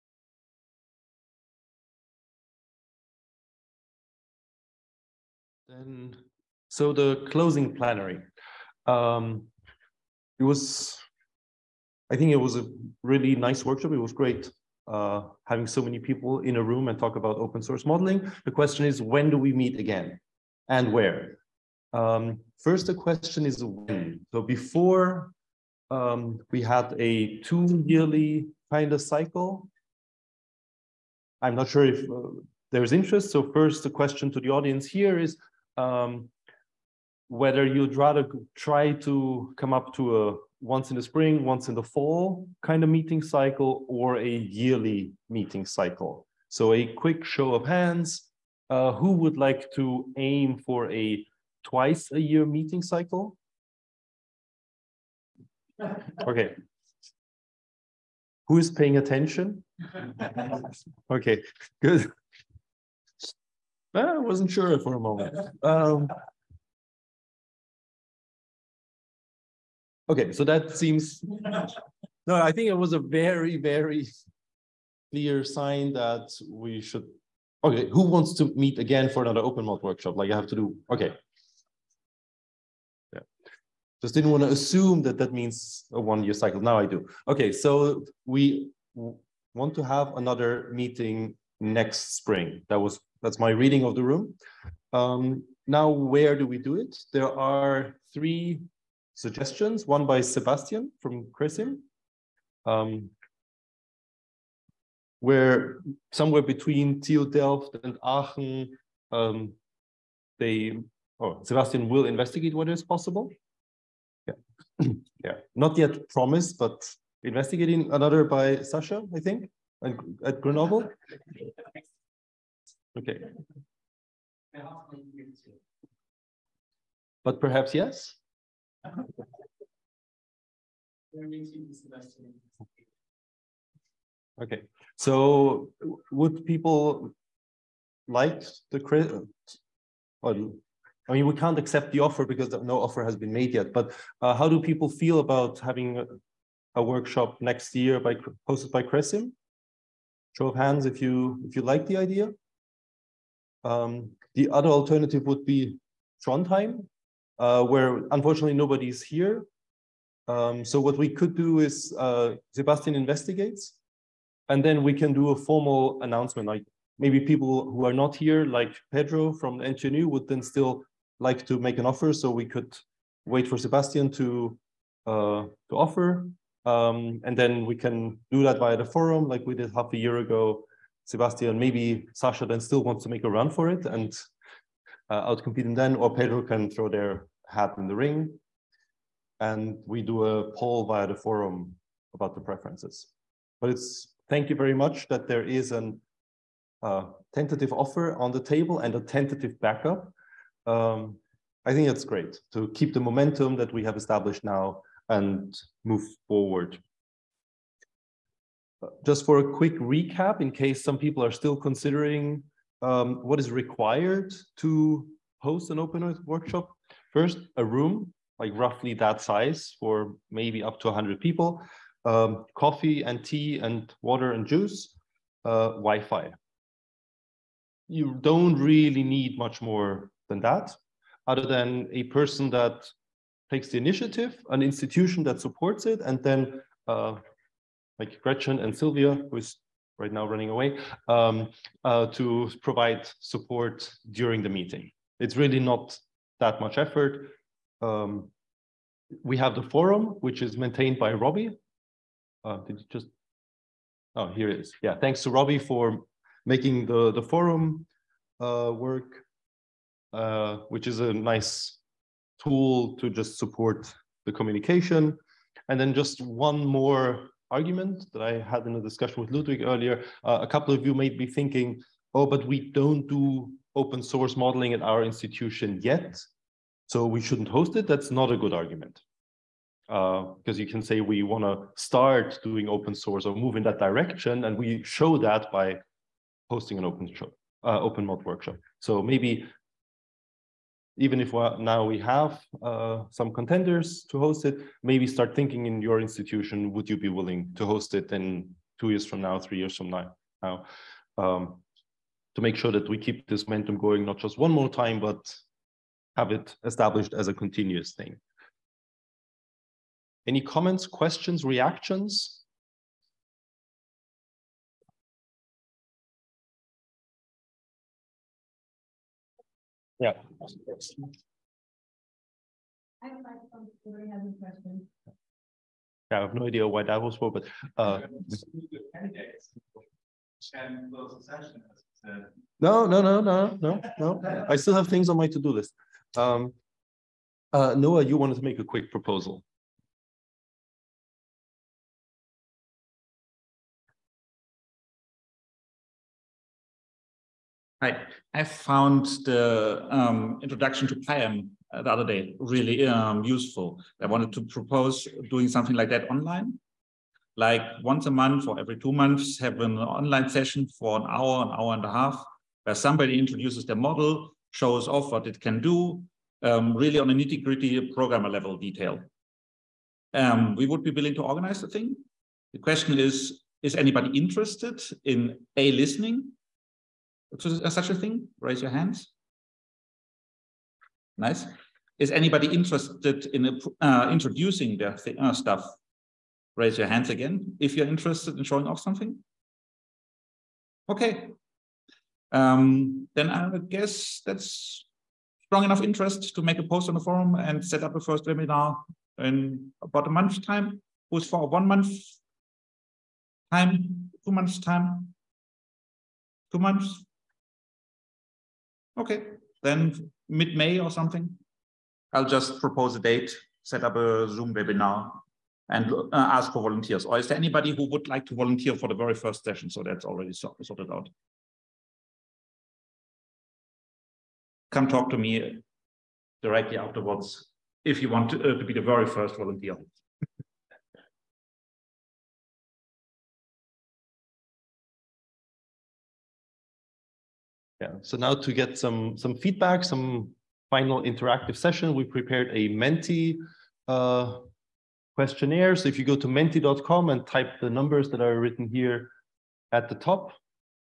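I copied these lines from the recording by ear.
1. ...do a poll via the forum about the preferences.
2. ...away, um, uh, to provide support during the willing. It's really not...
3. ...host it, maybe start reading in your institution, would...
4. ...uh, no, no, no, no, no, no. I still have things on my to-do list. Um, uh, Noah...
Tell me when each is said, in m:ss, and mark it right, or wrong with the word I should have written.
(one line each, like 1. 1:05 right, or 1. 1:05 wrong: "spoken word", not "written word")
1. 3:10 right
2. 4:00 wrong: "meeting", not "willing"
3. 4:54 wrong: "thinking", not "reading"
4. 5:27 right.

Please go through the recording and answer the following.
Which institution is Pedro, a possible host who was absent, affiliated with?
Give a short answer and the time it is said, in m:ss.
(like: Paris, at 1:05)
NTNU, at 2:49.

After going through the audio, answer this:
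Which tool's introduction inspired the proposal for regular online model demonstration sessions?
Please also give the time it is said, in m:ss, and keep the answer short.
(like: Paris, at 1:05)
pyam, at 5:51.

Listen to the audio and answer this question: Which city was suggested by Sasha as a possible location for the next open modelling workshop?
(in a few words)
Grenoble.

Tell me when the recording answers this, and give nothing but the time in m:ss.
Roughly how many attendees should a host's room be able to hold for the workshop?
3:40.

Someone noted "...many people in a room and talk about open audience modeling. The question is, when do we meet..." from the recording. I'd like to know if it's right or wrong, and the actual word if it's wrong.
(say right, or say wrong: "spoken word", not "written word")
wrong: "source", not "audience".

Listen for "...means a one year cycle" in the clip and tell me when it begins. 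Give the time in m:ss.
1:25.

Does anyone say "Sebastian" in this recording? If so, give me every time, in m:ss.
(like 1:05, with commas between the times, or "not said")
1:40, 1:51, 2:42, 2:53, 3:01.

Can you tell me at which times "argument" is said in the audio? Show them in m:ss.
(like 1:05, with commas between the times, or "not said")
4:27, 4:38.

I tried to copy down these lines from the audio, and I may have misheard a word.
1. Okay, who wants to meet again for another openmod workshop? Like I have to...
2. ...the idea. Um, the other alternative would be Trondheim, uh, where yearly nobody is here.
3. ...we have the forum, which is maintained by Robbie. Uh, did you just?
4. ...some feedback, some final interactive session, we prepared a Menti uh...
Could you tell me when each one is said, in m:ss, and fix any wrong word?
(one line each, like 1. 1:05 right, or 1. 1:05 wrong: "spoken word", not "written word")
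1. 1:17 right
2. 2:31 wrong: "unfortunately", not "yearly"
3. 4:09 right
4. 7:19 right.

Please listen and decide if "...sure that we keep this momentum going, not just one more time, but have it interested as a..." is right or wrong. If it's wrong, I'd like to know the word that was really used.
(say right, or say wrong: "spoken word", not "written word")
wrong: "established", not "interested".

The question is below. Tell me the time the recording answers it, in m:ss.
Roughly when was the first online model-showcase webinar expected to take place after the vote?
6:50.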